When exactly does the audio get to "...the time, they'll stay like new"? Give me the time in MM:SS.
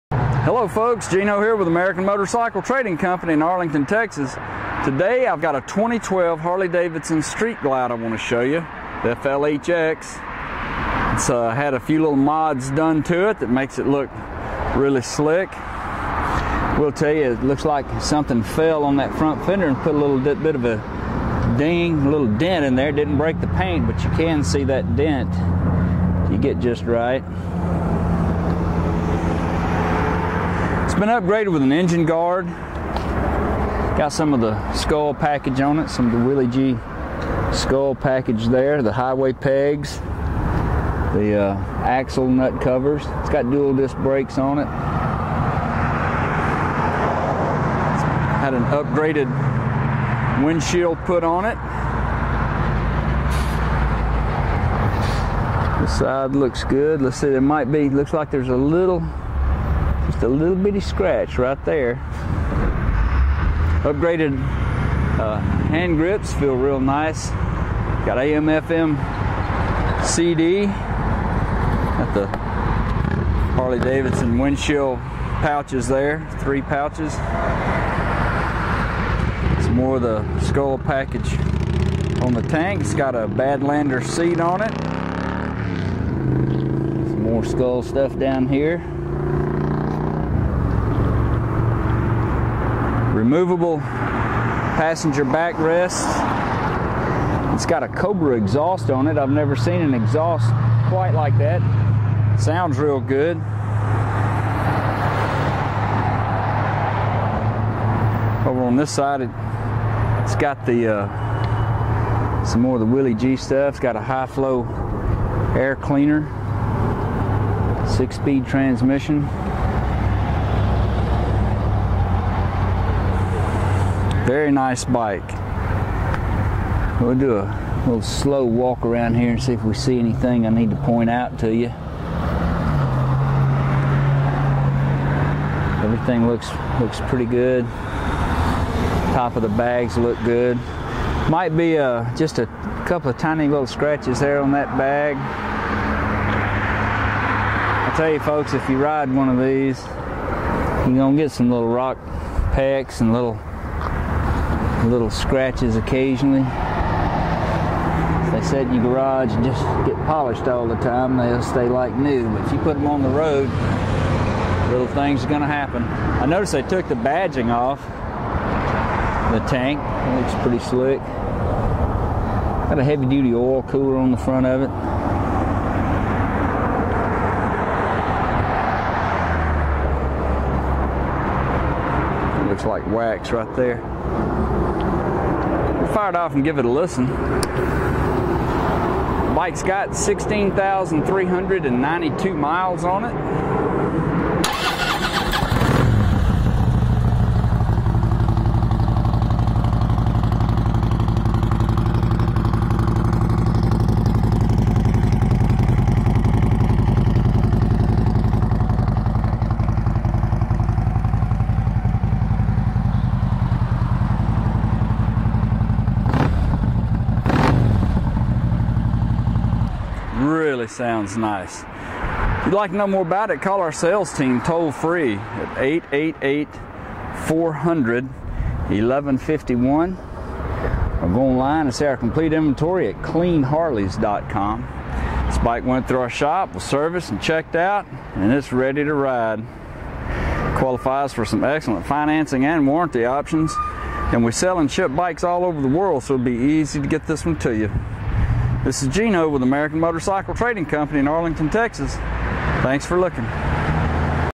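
02:40.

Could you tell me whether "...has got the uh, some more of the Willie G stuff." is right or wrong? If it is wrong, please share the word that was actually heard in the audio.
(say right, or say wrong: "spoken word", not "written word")
right.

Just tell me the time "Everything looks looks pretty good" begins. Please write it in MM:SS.
02:15.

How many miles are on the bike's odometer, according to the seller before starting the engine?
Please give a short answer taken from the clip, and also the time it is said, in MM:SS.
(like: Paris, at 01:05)
16,392, at 03:09.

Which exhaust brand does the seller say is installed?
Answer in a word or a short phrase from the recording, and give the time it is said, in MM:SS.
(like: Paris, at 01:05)
Cobra, at 01:37.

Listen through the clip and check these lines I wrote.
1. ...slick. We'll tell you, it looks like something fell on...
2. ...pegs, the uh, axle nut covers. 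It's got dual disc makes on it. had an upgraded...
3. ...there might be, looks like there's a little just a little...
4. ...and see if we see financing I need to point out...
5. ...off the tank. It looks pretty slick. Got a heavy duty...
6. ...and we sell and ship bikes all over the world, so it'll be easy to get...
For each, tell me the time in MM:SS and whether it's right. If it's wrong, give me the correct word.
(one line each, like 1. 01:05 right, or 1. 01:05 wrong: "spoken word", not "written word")
1. 00:15 right
2. 00:39 wrong: "brakes", not "makes"
3. 00:57 right
4. 02:09 wrong: "anything", not "financing"
5. 02:47 right
6. 04:04 right.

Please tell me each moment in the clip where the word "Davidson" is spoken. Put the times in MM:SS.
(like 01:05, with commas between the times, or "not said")
00:06, 01:13.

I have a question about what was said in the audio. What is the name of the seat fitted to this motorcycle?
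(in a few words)
Badlander.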